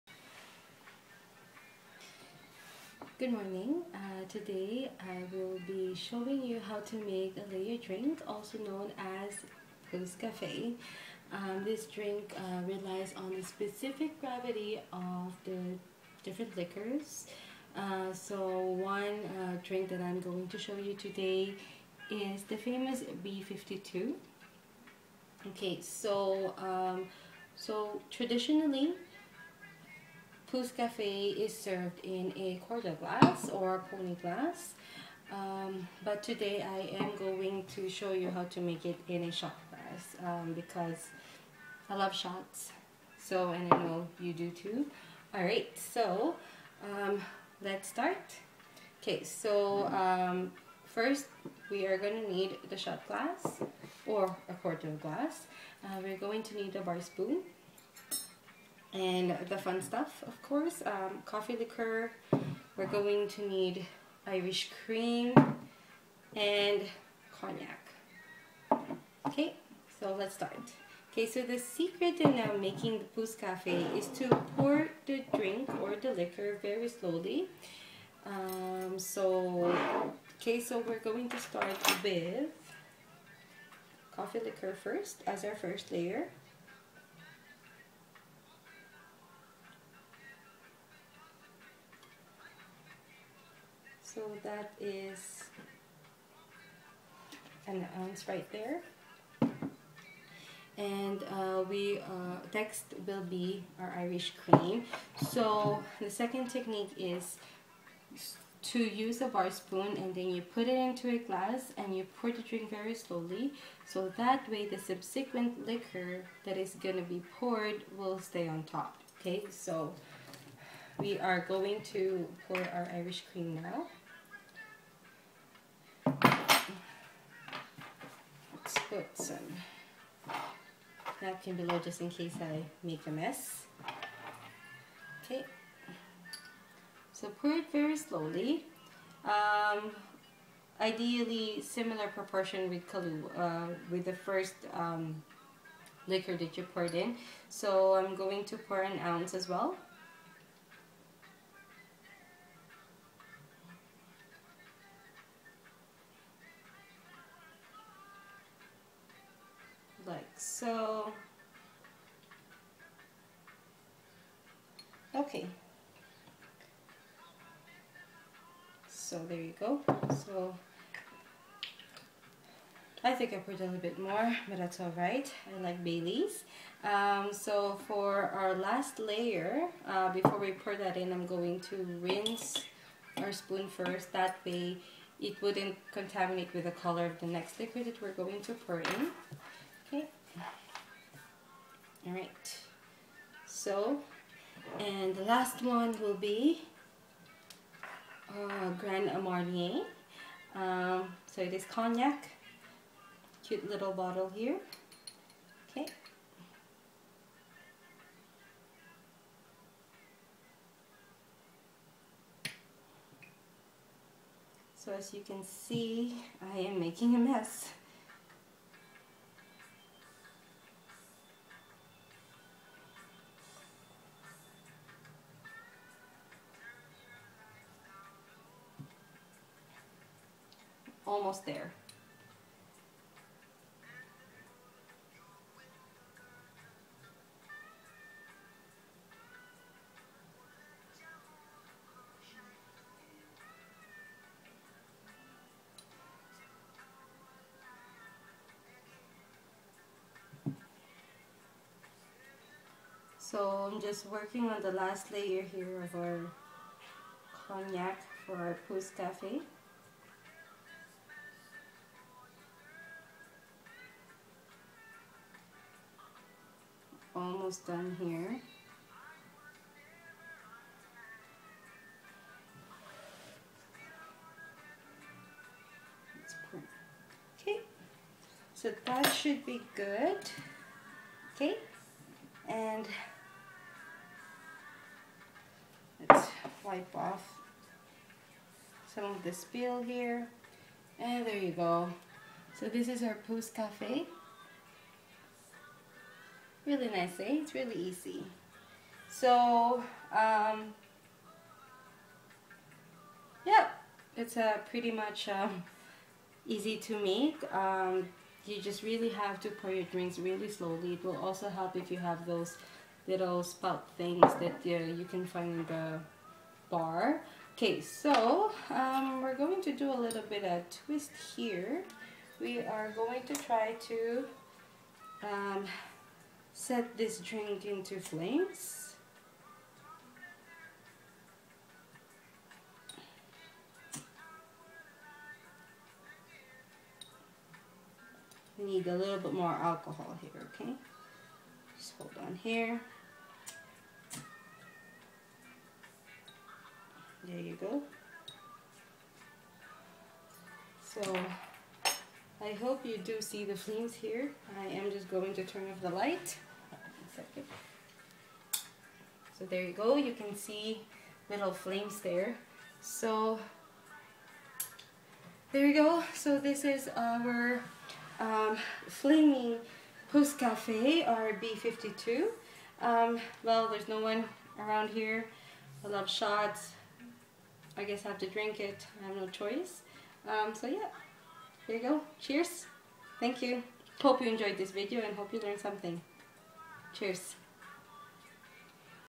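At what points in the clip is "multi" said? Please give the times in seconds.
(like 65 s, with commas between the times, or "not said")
not said.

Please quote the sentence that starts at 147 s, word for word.
So I'm going to pour an ounce as well.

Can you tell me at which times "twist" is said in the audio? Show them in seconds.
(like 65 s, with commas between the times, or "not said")
320 s.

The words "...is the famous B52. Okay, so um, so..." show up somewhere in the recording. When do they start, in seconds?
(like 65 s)
22 s.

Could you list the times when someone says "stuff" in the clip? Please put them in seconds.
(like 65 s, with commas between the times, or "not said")
59 s.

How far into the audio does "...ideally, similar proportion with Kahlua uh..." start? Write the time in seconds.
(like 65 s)
140 s.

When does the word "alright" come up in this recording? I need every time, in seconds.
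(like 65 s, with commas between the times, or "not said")
45 s, 174 s.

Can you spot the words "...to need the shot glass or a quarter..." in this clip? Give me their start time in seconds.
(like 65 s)
52 s.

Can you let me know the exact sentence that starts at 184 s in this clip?
That way it wouldn't contaminate with the color of the next liquid that we're going to pour in.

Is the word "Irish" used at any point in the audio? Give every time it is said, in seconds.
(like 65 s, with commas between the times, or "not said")
64 s, 103 s, 122 s.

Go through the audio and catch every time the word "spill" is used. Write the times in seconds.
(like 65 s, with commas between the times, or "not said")
289 s.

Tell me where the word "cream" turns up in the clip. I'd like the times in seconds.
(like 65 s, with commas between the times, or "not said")
64 s, 104 s, 123 s.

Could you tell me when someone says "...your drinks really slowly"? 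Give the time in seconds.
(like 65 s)
309 s.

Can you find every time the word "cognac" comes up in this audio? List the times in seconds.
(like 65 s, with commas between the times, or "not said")
67 s, 201 s, 257 s.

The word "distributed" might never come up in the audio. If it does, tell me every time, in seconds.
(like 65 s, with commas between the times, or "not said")
not said.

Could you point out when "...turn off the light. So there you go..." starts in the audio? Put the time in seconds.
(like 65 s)
355 s.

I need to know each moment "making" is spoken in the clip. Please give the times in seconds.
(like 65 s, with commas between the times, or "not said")
72 s, 216 s.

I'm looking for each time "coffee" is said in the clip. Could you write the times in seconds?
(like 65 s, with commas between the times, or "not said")
61 s, 84 s.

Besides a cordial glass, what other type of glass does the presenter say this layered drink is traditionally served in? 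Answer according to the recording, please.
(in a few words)
pony glass.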